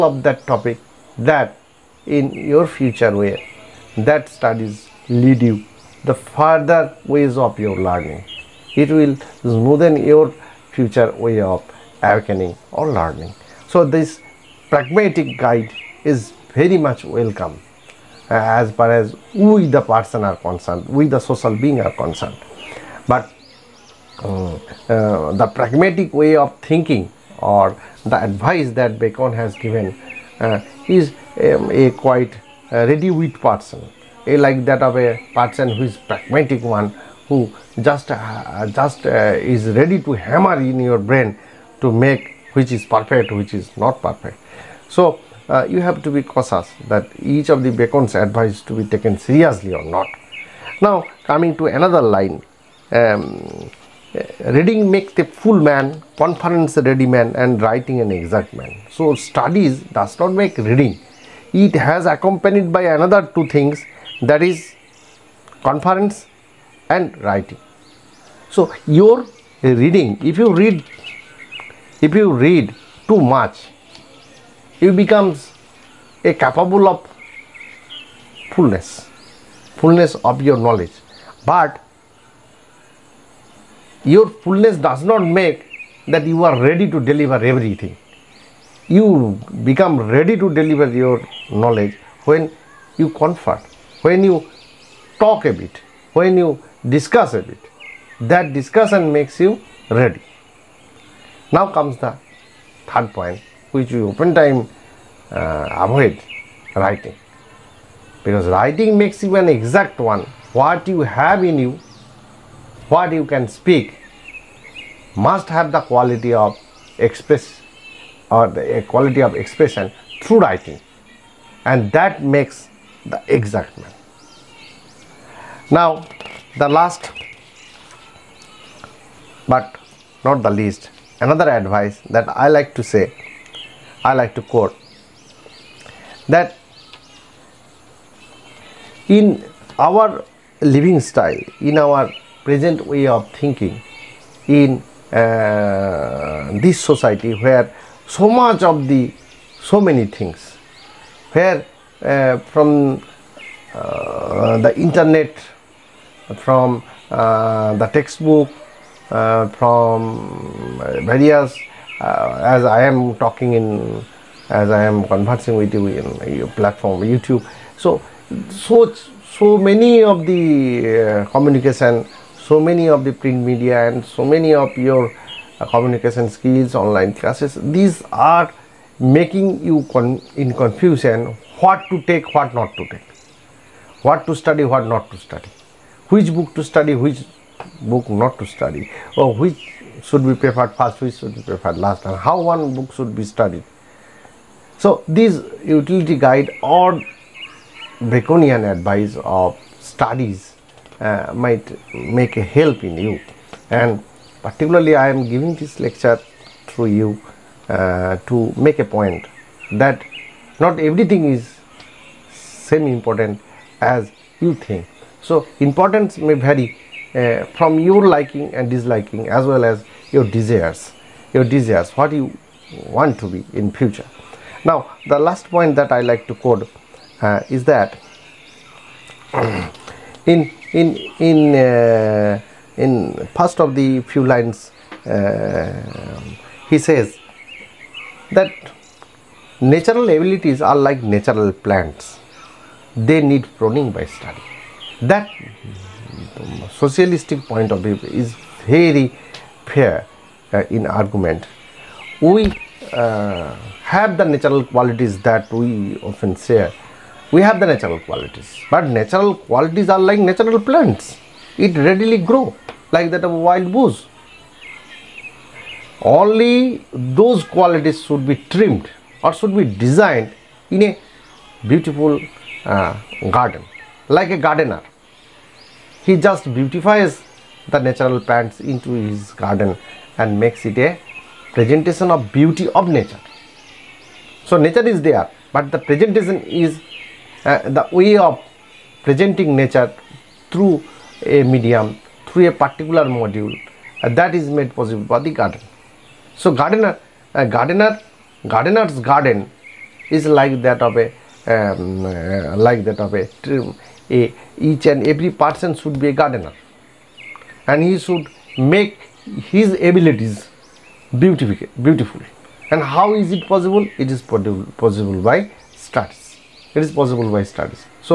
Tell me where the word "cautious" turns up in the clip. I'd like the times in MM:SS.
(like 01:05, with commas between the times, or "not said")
00:46.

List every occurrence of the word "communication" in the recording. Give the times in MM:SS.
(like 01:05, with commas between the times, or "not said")
02:51, 02:55.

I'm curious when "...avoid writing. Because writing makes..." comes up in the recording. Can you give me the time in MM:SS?
01:45.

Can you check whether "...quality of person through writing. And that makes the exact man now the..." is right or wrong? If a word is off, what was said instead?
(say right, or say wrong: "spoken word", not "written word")
wrong: "expression", not "person".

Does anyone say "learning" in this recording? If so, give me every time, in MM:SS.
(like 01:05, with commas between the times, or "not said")
00:07, 00:12.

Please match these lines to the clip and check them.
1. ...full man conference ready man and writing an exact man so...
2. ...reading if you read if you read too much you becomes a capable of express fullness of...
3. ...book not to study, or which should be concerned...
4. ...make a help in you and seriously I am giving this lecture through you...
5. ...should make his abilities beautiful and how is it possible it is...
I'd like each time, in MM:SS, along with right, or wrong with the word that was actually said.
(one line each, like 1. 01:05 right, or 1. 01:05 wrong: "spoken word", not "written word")
1. 00:55 right
2. 01:09 wrong: "fullness", not "express"
3. 03:07 wrong: "preferred", not "concerned"
4. 03:21 wrong: "particularly", not "seriously"
5. 05:07 right.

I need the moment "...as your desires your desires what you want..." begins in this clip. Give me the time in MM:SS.
03:39.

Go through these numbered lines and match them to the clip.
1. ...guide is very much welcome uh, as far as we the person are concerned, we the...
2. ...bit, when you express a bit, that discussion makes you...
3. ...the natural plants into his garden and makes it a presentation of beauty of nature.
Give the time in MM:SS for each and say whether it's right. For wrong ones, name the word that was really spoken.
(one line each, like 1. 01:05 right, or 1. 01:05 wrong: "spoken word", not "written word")
1. 00:15 right
2. 01:35 wrong: "discuss", not "express"
3. 04:37 right.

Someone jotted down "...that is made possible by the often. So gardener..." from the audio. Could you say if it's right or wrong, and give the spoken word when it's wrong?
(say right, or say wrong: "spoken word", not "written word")
wrong: "garden", not "often".